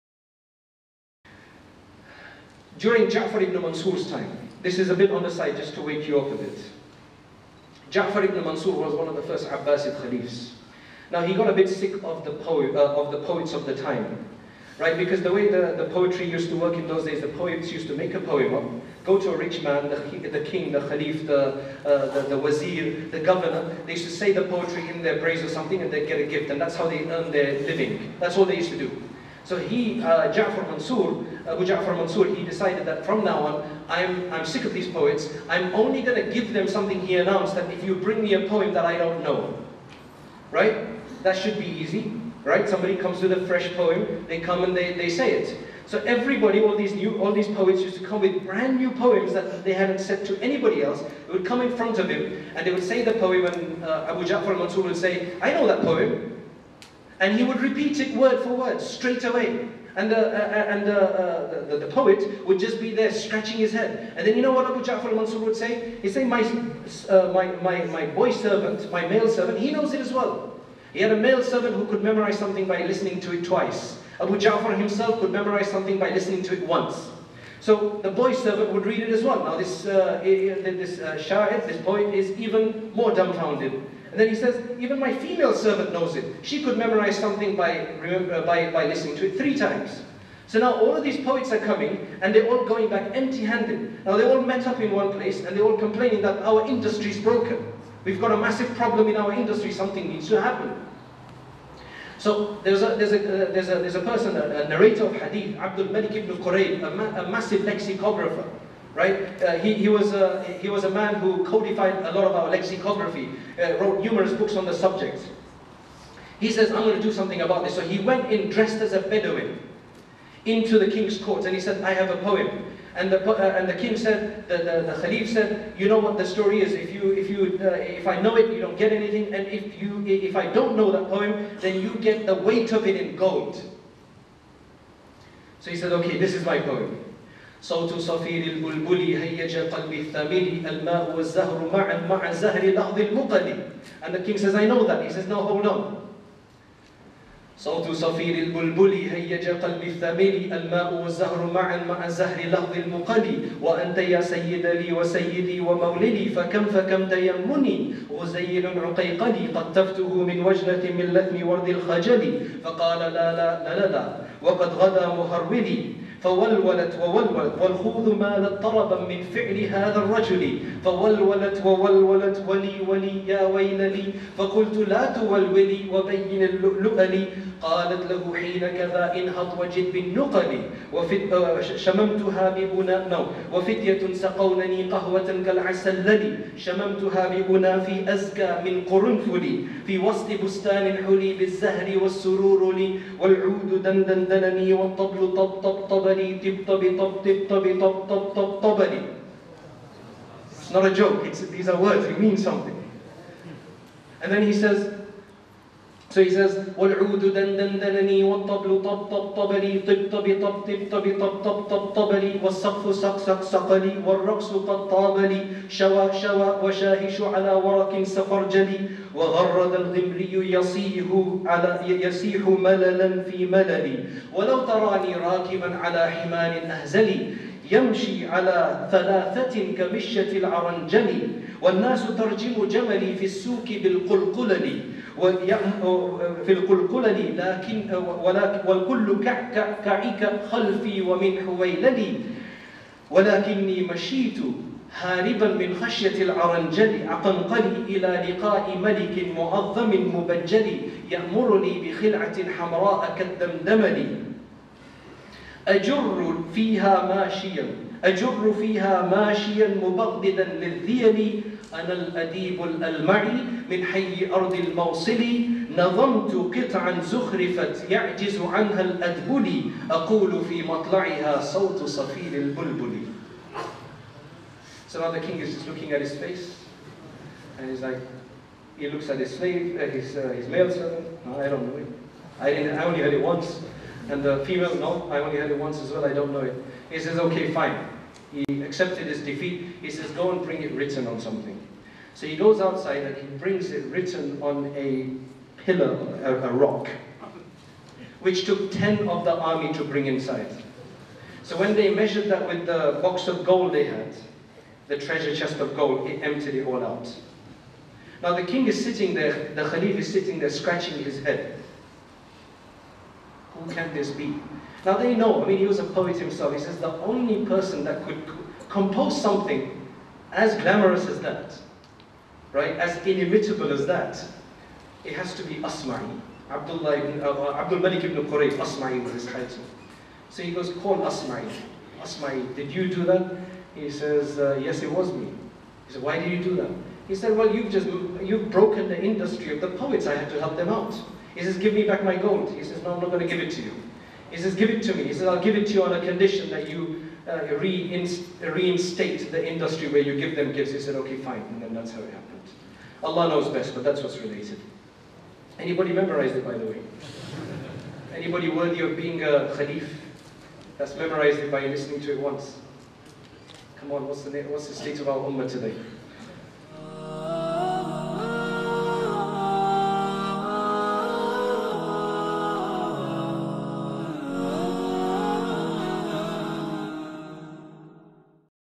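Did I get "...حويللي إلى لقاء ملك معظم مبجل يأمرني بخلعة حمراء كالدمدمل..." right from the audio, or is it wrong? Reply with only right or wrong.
wrong.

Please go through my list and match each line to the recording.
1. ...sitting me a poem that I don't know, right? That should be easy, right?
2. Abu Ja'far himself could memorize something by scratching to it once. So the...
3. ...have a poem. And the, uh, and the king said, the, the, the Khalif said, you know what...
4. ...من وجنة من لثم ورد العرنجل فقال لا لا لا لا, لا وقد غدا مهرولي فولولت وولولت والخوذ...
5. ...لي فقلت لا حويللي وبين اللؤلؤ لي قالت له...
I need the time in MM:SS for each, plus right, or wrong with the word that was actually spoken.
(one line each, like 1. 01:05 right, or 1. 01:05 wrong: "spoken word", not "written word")
1. 00:37 wrong: "bring", not "sitting"
2. 01:14 wrong: "listening", not "scratching"
3. 02:01 right
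4. 02:40 wrong: "الخجل", not "العرنجل"
5. 02:53 wrong: "تولولي", not "حويللي".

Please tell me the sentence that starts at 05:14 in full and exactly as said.
Now they know, I mean, he was a poet himself.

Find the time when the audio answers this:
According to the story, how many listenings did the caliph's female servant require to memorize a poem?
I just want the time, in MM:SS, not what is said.
01:29.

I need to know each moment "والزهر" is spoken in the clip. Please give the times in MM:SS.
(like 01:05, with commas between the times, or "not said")
02:21, 02:31.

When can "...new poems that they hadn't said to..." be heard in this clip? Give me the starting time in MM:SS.
00:48.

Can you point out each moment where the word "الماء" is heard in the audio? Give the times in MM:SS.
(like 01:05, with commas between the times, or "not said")
02:20, 02:30.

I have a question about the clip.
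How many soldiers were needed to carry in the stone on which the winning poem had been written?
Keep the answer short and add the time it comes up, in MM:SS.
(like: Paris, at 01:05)
10, at 04:58.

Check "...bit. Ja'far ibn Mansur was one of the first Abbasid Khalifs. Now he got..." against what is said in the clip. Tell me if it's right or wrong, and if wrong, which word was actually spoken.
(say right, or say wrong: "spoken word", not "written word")
right.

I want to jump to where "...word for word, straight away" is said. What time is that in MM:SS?
00:58.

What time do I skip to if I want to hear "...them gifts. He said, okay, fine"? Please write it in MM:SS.
05:50.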